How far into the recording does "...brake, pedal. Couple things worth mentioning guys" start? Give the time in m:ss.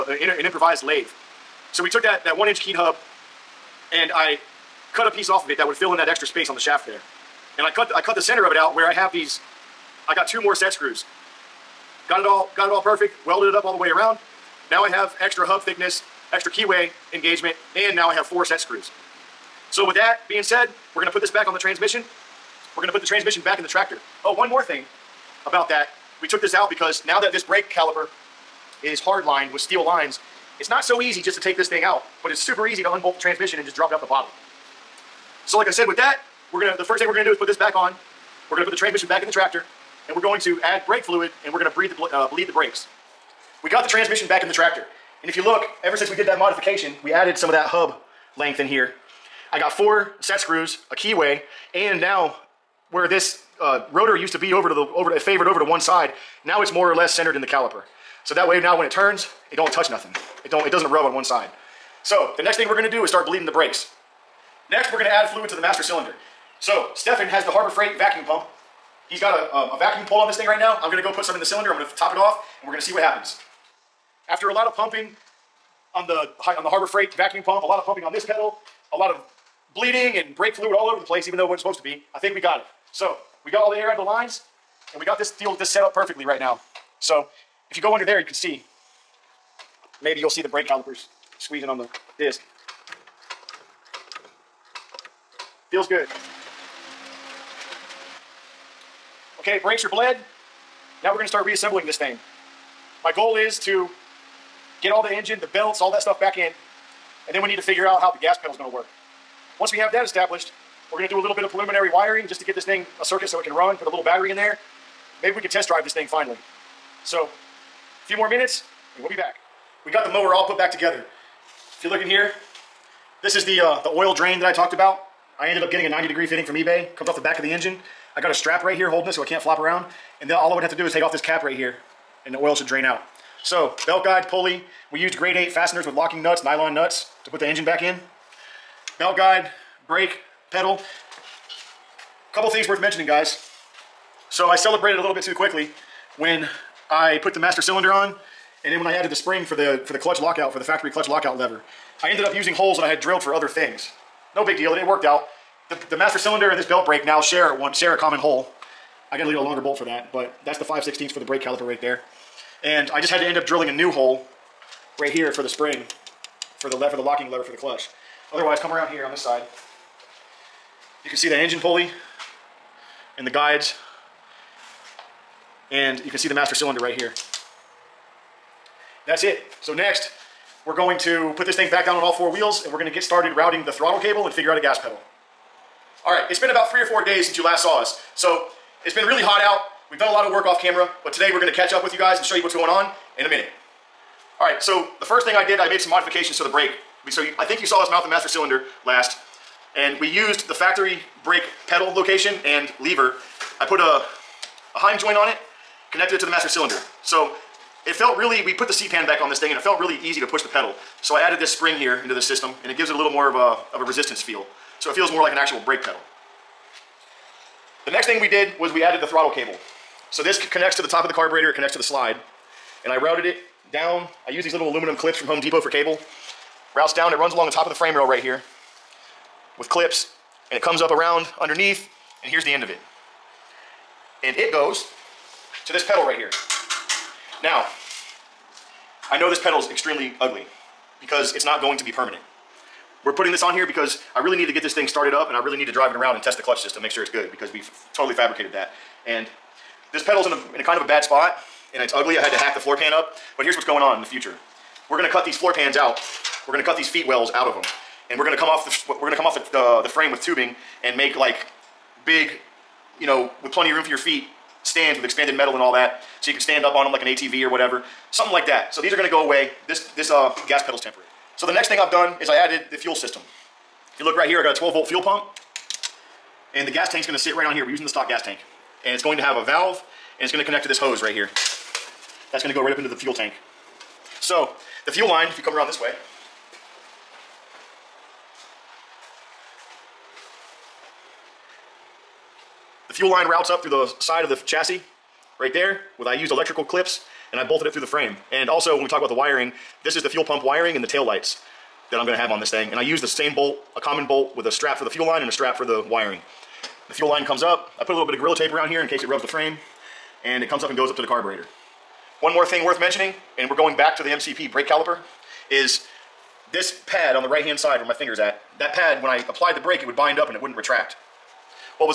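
2:19.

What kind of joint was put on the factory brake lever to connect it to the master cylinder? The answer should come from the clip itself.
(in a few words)
Heim joint.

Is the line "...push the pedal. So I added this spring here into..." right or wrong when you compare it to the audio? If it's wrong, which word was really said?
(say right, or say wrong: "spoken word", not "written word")
right.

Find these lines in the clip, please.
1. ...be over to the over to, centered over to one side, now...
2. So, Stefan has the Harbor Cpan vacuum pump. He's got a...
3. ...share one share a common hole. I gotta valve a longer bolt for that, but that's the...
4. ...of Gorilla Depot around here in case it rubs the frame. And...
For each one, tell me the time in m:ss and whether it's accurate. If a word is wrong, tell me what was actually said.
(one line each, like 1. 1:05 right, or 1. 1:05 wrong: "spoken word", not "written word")
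1. 0:54 wrong: "favored", not "centered"
2. 1:06 wrong: "Freight", not "Cpan"
3. 2:37 wrong: "leave", not "valve"
4. 5:08 wrong: "Tape", not "Depot".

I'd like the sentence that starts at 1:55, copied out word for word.
Maybe we can test drive this thing finally.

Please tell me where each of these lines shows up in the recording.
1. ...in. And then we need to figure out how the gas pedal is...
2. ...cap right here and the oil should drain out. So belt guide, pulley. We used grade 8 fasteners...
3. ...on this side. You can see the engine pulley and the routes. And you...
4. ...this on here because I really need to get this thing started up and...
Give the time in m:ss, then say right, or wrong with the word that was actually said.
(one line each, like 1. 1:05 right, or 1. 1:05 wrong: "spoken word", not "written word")
1. 1:46 right
2. 2:11 right
3. 2:49 wrong: "guides", not "routes"
4. 4:03 right.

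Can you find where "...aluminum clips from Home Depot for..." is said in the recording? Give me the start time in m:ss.
3:44.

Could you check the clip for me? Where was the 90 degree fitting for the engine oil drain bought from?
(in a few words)
eBay.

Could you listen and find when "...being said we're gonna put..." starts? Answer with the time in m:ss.
0:20.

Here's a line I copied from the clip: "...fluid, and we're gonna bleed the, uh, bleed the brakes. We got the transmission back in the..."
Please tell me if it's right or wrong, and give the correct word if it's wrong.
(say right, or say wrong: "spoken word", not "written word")
right.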